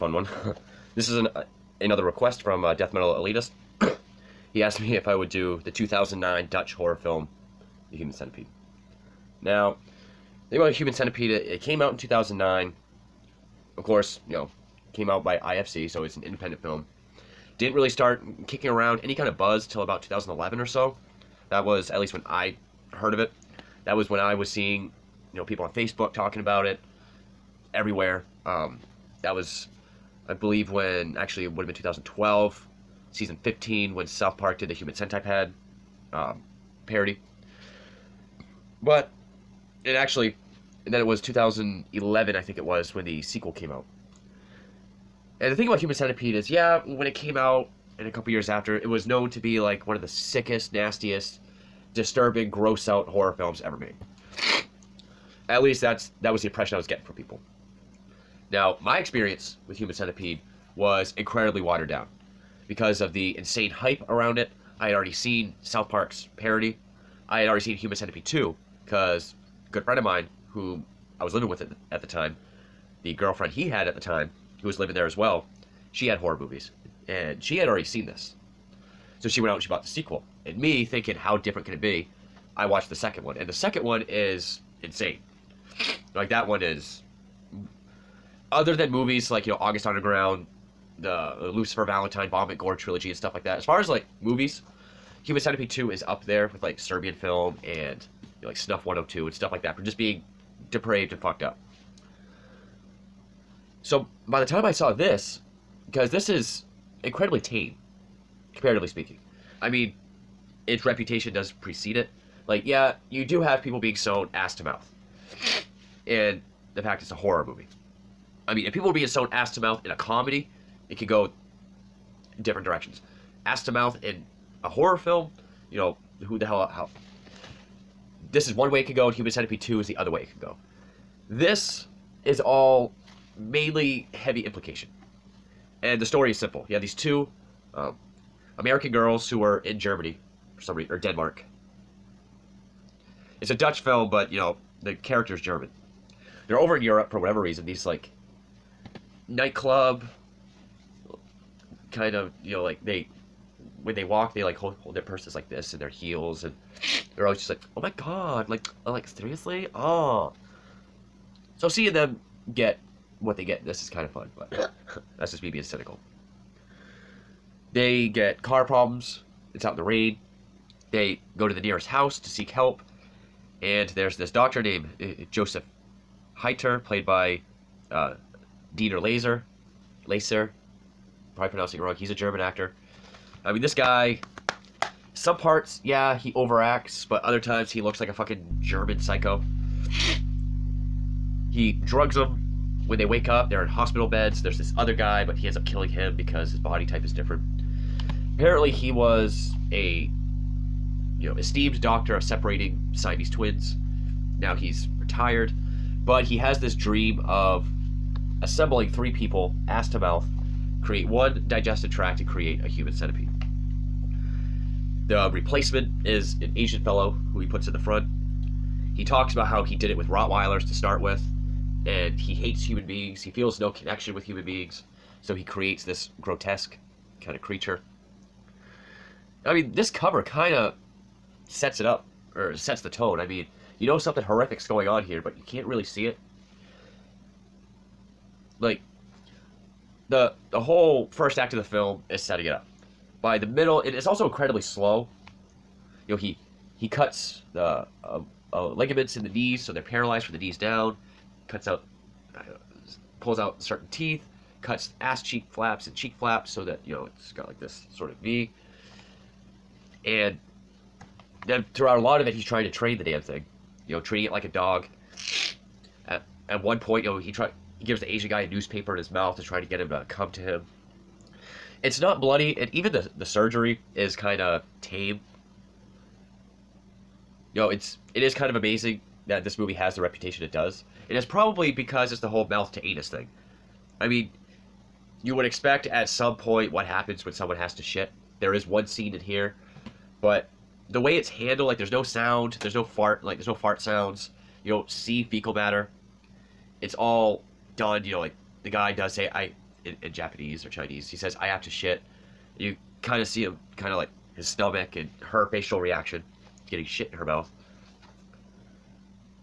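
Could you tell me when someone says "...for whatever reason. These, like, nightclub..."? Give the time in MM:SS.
02:27.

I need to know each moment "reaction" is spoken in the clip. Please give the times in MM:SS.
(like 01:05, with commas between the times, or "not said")
05:05.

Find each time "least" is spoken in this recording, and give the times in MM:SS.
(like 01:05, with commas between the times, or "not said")
00:21, 00:55.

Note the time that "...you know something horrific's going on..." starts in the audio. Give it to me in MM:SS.
03:53.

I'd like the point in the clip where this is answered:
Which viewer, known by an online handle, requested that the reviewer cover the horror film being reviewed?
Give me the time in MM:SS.
00:02.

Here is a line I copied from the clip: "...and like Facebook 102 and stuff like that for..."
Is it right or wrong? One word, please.
wrong.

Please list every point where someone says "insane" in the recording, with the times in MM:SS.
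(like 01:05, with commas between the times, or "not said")
01:03, 01:24.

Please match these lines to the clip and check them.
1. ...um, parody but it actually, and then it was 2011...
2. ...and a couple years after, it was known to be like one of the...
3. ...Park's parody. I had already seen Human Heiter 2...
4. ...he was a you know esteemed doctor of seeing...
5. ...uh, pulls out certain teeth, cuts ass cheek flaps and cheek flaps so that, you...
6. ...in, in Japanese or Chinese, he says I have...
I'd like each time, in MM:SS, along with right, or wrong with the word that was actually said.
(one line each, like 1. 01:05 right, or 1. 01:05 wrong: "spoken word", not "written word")
1. 00:36 right
2. 00:47 right
3. 01:05 wrong: "Centipede", not "Heiter"
4. 03:18 wrong: "separating", not "seeing"
5. 04:12 right
6. 04:59 right.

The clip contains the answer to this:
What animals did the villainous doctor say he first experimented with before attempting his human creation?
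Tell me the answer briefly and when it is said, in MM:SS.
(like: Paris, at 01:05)
Rottweilers, at 03:40.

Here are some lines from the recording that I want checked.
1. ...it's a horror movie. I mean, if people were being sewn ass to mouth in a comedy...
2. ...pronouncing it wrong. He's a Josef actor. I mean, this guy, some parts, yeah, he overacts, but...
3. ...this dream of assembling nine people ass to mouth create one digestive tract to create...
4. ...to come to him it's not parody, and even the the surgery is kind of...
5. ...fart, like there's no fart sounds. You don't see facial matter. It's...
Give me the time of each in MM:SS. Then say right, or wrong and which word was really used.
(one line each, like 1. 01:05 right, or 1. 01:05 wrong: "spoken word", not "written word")
1. 01:57 right
2. 03:01 wrong: "German", not "Josef"
3. 03:26 wrong: "three", not "nine"
4. 04:29 wrong: "bloody", not "parody"
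5. 04:52 wrong: "fecal", not "facial".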